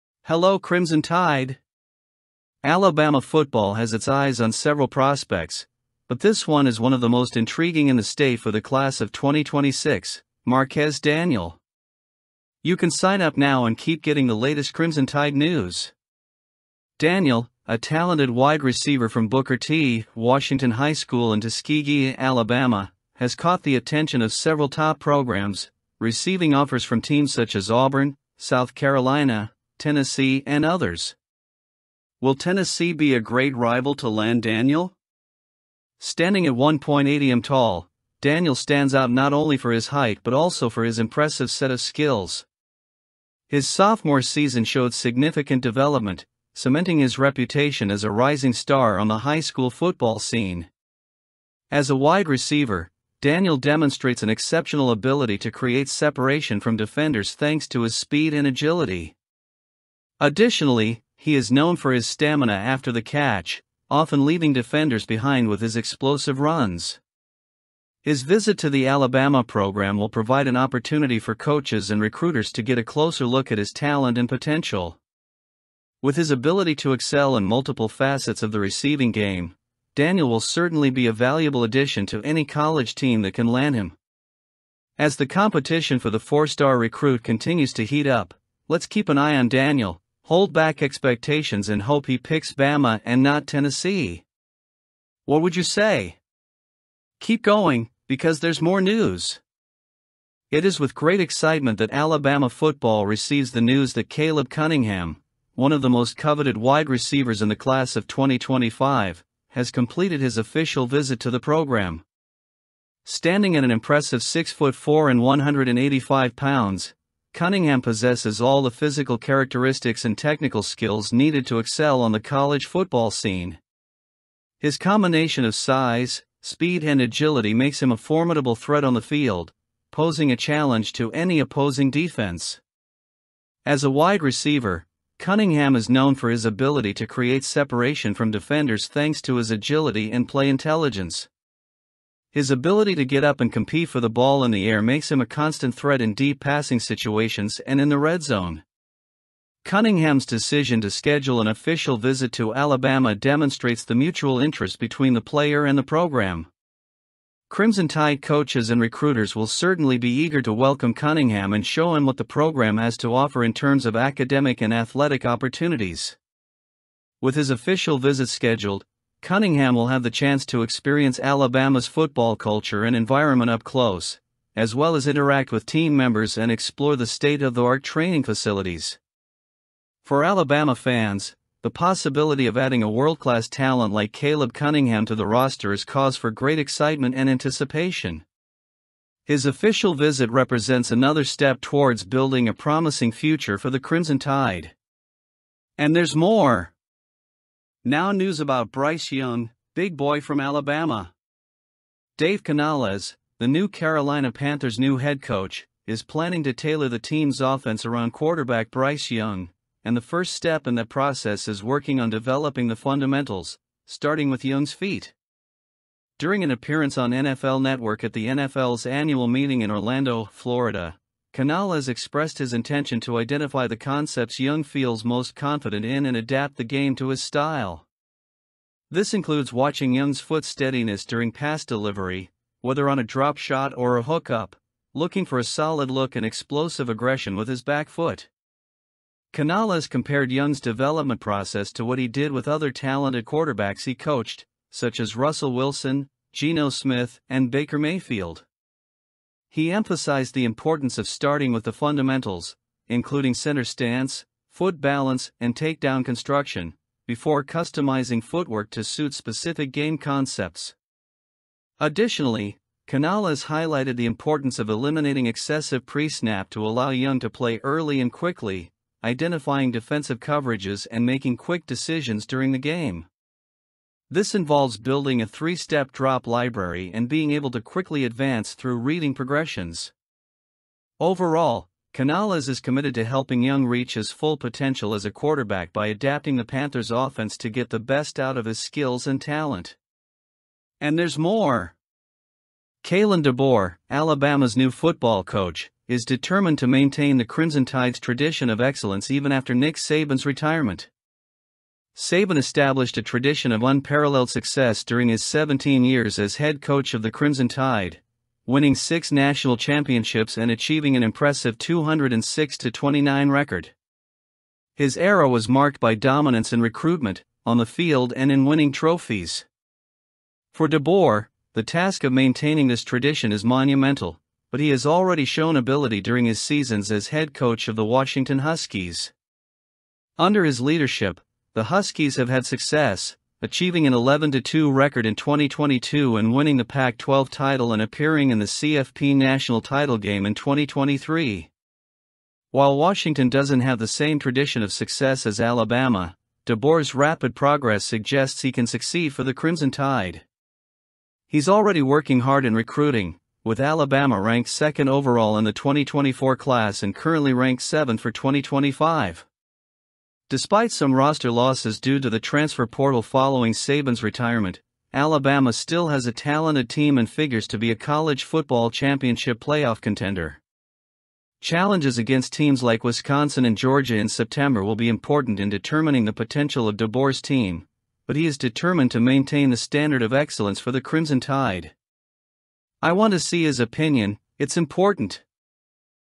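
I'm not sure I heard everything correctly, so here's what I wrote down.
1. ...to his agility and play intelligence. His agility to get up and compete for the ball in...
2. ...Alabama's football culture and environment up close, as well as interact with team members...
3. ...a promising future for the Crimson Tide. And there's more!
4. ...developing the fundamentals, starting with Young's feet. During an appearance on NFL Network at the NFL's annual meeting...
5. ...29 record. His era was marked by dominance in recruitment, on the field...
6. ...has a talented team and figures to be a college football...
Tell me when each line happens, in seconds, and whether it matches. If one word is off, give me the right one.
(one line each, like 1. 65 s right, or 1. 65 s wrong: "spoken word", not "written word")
1. 139 s wrong: "ability", not "agility"
2. 171 s right
3. 192 s right
4. 212 s right
5. 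312 s right
6. 365 s right.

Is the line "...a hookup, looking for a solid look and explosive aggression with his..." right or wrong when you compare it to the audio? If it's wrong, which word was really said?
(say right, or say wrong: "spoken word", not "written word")
right.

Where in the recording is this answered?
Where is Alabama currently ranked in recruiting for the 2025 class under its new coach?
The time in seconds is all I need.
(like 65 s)
357 s.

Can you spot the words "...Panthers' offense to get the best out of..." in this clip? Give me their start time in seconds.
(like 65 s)
286 s.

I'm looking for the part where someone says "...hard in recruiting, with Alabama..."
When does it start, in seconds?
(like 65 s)
352 s.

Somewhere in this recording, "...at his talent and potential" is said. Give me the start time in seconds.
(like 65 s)
73 s.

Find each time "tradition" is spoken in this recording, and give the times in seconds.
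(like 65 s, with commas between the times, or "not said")
297 s, 303 s, 322 s, 344 s.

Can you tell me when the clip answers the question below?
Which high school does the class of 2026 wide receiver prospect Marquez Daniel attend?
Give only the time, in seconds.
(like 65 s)
19 s.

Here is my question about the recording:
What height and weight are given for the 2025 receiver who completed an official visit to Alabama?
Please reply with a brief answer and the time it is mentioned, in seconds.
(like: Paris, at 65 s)
6 foot 4, 185 pounds, at 114 s.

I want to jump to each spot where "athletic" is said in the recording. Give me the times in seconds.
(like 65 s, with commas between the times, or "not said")
164 s.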